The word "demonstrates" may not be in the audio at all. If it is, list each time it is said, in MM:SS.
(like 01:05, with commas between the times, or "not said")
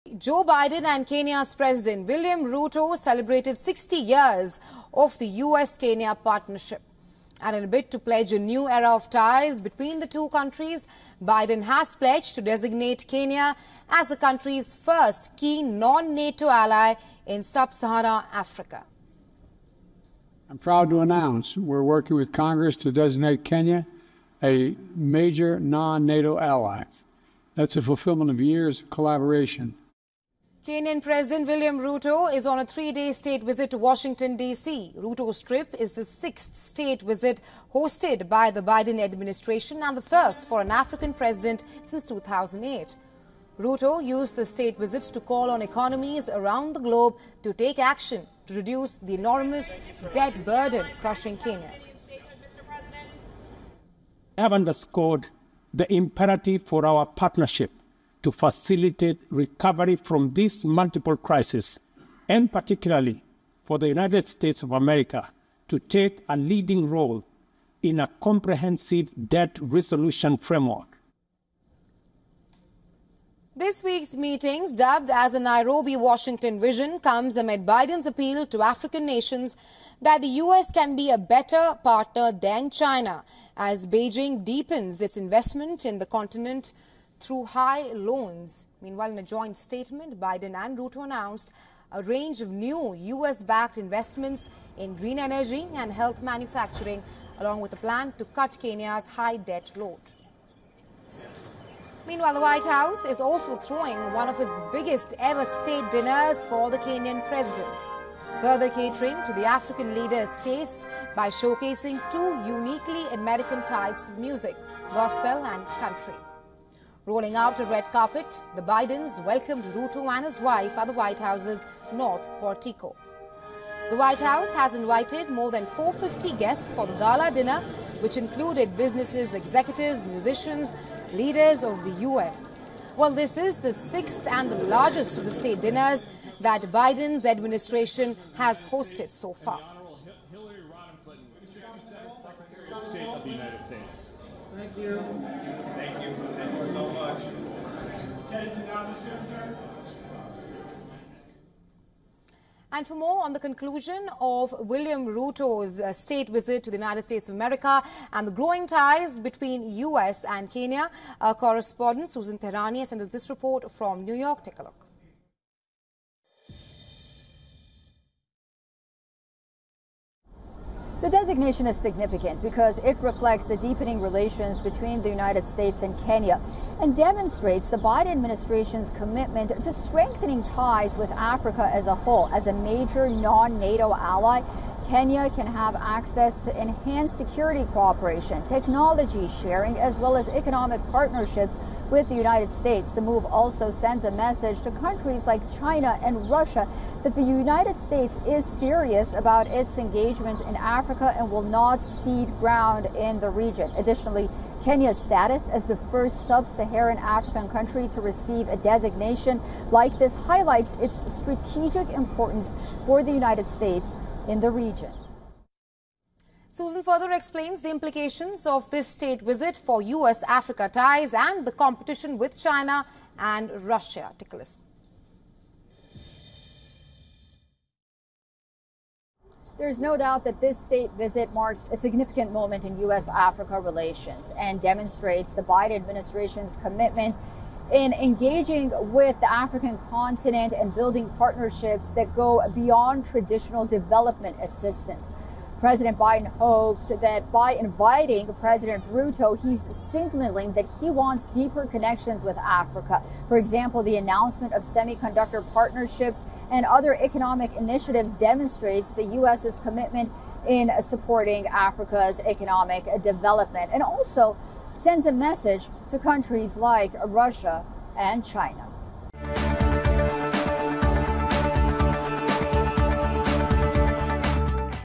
02:56, 03:54, 04:18.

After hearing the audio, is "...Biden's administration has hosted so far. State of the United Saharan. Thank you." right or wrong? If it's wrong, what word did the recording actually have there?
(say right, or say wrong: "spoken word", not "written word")
wrong: "States", not "Saharan".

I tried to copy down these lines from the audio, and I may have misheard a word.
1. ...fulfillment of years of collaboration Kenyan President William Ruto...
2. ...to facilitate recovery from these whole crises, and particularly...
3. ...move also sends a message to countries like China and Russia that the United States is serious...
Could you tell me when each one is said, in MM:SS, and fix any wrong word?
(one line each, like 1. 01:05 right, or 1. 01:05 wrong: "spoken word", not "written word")
1. 00:27 right
2. 00:58 wrong: "multiple", not "whole"
3. 03:12 right.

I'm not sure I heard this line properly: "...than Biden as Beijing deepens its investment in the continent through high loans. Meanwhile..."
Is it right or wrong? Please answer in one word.
wrong.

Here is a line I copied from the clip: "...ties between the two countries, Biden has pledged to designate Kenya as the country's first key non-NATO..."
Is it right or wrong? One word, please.
right.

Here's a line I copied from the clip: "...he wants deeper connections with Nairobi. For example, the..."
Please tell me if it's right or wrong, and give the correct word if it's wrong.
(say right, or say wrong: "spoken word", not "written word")
wrong: "Africa", not "Nairobi".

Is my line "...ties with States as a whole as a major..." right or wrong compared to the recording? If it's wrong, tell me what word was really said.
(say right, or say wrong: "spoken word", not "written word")
wrong: "Africa", not "States".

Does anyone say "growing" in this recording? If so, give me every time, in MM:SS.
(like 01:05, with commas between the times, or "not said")
02:38.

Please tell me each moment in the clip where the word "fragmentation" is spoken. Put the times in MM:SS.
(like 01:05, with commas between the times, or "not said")
not said.